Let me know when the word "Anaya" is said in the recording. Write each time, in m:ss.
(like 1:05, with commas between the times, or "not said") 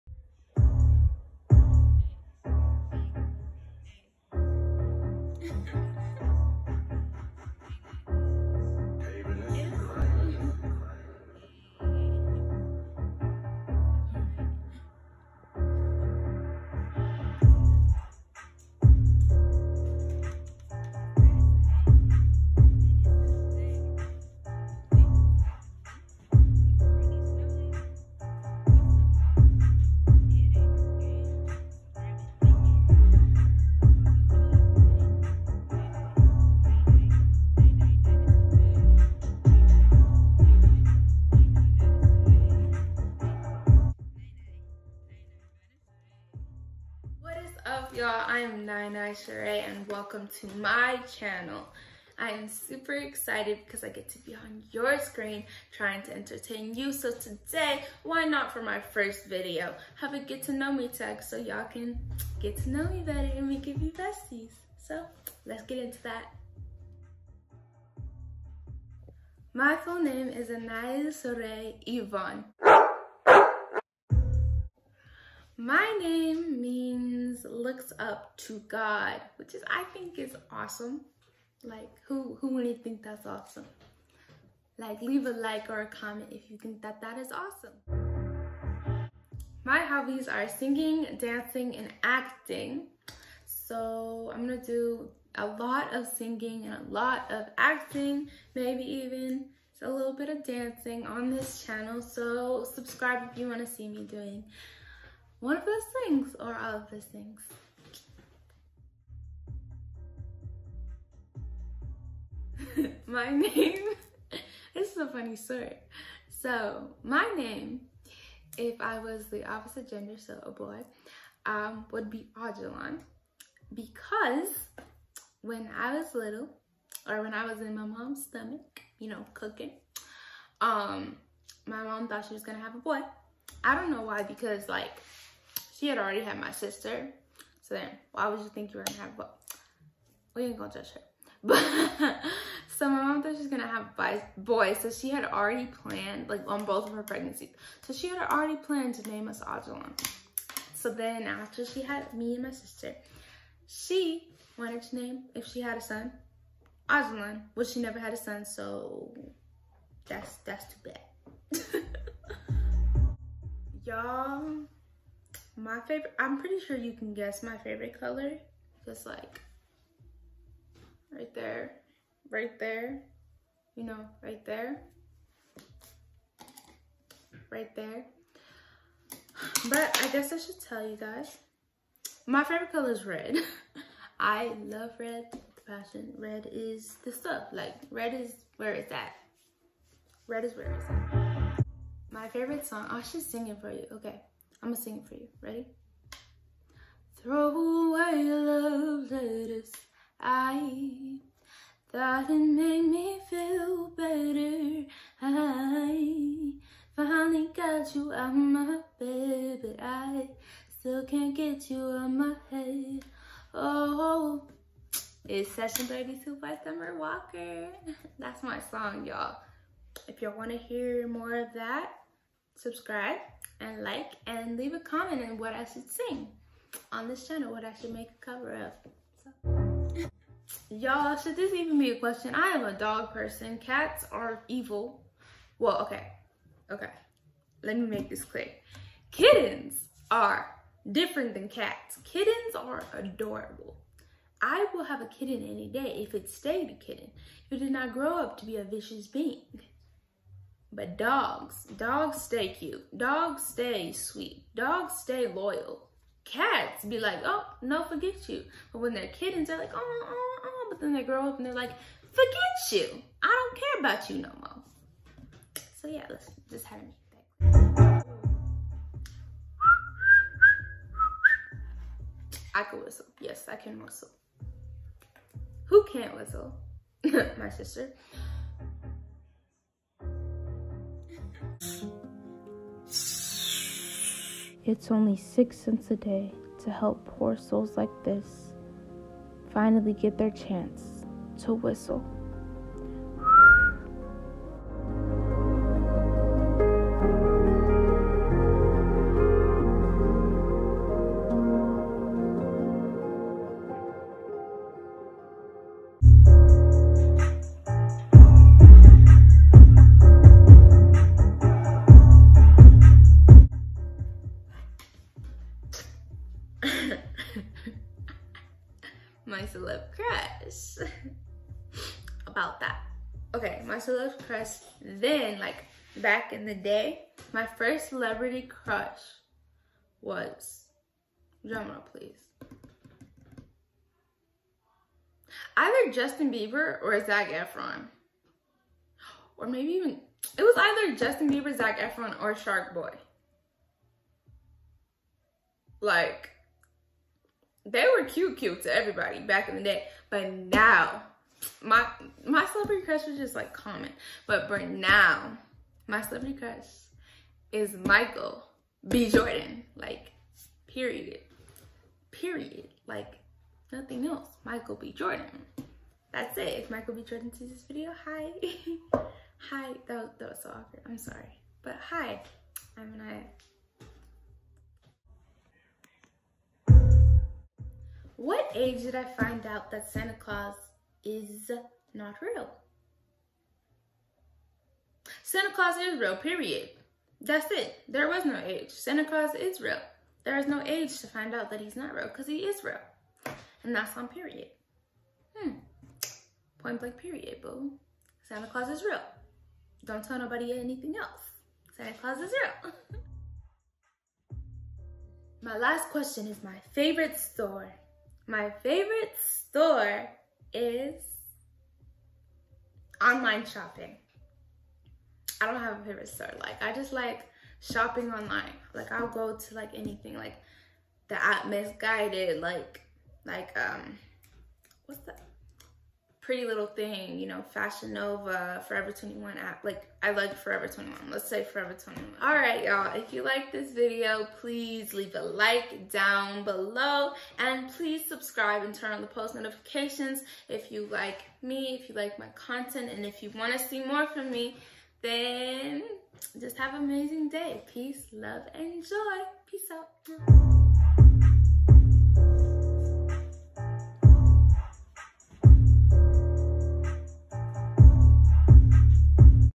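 1:10.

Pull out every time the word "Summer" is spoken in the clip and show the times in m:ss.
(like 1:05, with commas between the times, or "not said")
3:36.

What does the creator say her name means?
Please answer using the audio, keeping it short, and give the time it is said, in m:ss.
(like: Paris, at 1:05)
Looks up to God, at 1:17.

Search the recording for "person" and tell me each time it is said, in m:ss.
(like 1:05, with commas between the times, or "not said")
3:53.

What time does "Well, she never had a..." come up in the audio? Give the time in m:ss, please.
2:37.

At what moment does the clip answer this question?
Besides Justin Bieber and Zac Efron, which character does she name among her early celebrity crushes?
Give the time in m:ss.
5:42.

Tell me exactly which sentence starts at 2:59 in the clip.
But I guess I should tell you guys, my favorite color is red.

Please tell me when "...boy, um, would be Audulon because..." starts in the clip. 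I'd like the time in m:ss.
2:00.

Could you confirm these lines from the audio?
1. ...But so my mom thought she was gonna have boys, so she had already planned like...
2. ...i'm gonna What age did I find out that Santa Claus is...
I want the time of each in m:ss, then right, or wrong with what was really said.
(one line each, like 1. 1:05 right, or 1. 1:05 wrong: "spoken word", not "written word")
1. 2:21 right
2. 6:12 right.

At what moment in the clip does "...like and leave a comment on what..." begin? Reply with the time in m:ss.
3:43.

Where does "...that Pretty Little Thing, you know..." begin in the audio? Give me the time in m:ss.
7:05.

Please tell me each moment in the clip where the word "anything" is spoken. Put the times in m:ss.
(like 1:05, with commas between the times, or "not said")
6:40, 6:59.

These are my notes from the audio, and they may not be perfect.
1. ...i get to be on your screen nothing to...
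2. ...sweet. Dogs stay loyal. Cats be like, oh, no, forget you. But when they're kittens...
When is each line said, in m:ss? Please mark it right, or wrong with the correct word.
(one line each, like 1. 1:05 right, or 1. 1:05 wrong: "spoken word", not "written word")
1. 0:53 wrong: "trying", not "nothing"
2. 4:13 right.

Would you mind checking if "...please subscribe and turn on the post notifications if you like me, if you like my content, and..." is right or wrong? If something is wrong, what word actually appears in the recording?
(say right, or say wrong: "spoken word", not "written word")
right.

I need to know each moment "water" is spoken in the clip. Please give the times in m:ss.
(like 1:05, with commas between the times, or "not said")
not said.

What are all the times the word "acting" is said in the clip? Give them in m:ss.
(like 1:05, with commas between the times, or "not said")
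1:32, 1:37.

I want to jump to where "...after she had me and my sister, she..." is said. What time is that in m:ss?
2:31.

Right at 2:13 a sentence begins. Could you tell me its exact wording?
I don't know why because like she had already had my sister.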